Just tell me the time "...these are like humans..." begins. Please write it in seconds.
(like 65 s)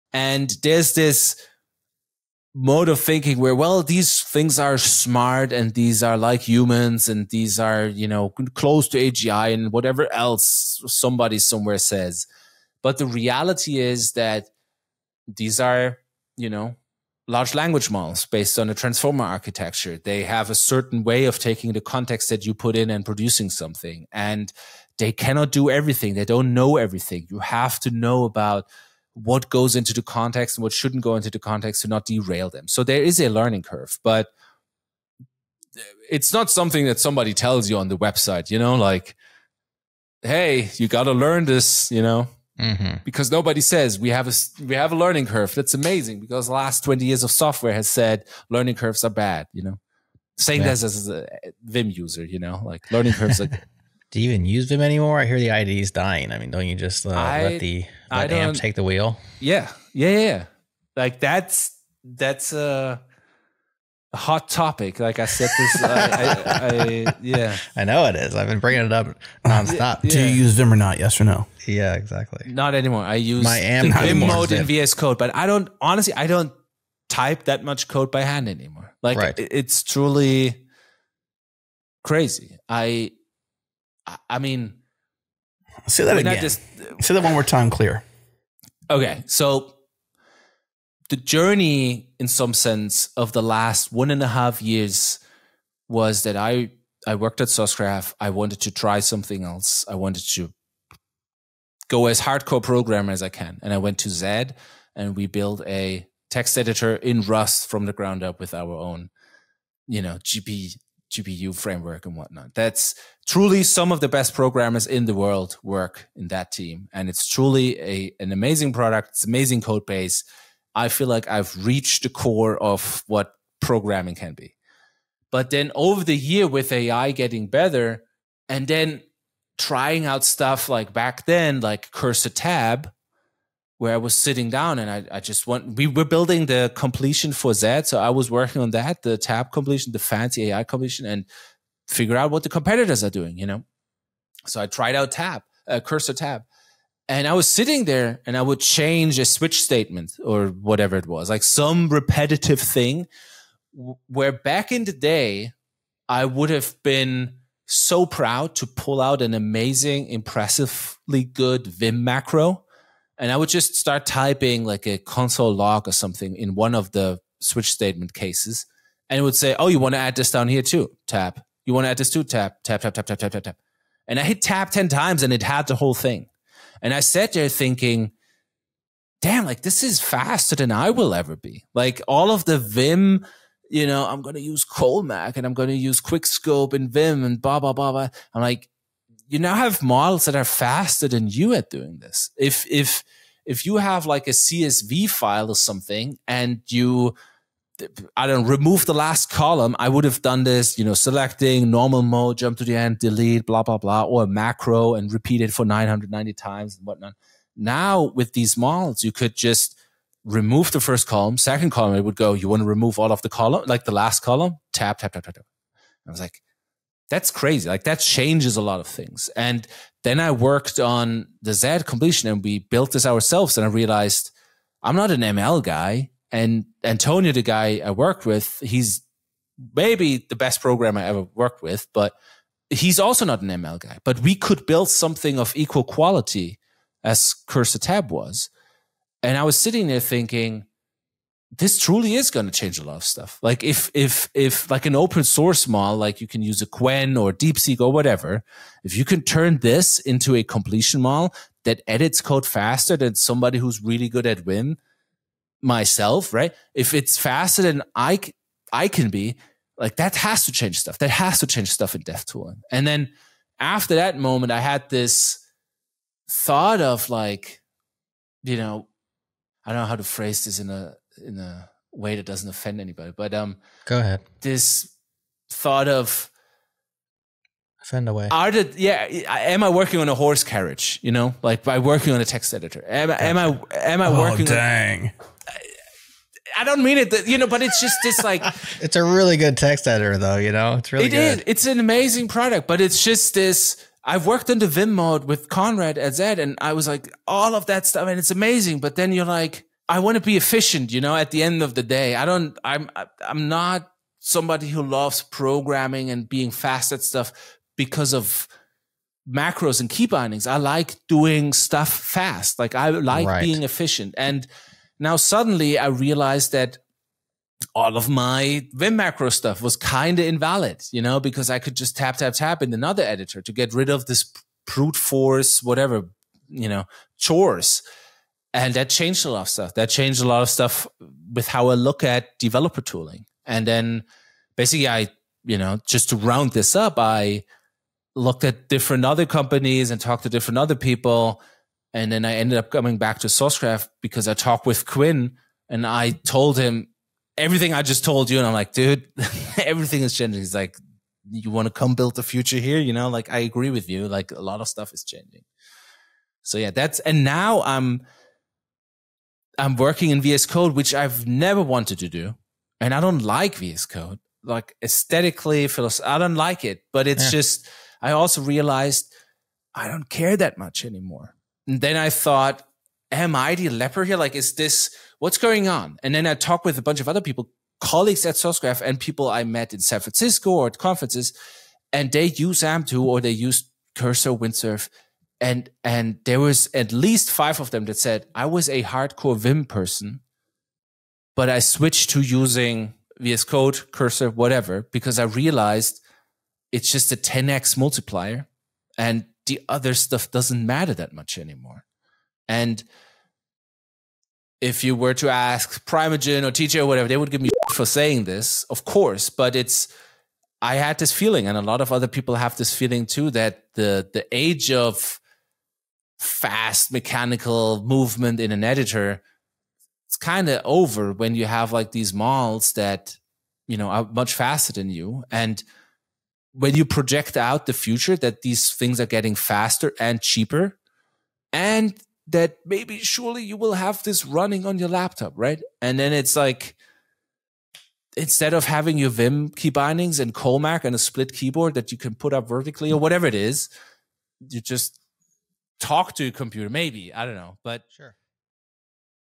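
5 s.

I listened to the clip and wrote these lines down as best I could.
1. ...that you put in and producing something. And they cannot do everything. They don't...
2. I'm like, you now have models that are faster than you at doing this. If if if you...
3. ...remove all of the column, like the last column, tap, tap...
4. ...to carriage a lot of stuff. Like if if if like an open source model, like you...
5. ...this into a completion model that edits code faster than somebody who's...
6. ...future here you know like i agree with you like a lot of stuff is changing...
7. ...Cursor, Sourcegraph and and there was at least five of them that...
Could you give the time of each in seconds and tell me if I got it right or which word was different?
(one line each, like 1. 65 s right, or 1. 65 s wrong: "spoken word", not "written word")
1. 22 s right
2. 188 s right
3. 212 s right
4. 242 s wrong: "change", not "carriage"
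5. 249 s right
6. 352 s right
7. 383 s wrong: "Windsurf", not "Sourcegraph".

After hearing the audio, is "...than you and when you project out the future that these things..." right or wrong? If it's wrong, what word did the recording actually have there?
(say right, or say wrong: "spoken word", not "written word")
right.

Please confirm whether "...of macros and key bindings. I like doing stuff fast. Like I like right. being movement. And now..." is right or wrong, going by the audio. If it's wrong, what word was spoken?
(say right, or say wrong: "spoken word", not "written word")
wrong: "efficient", not "movement".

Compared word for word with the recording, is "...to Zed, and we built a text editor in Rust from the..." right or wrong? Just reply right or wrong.
right.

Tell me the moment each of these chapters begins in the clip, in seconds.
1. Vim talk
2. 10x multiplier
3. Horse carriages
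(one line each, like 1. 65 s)
1. 54 s
2. 360 s
3. 280 s.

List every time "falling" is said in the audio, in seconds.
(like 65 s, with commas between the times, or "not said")
not said.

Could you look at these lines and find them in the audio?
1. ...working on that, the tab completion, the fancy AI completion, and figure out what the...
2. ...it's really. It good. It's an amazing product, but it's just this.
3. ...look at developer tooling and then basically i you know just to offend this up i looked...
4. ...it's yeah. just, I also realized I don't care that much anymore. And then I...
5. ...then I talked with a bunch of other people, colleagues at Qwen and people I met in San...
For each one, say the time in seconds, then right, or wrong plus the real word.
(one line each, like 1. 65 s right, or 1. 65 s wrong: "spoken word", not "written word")
1. 138 s right
2. 290 s right
3. 331 s wrong: "round", not "offend"
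4. 367 s right
5. 376 s wrong: "Sourcegraph", not "Qwen".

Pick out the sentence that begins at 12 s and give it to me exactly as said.
But the reality is that these are, you know, large language models based on a transformer architecture.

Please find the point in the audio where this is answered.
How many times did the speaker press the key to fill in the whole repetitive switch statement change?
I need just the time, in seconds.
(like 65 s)
174 s.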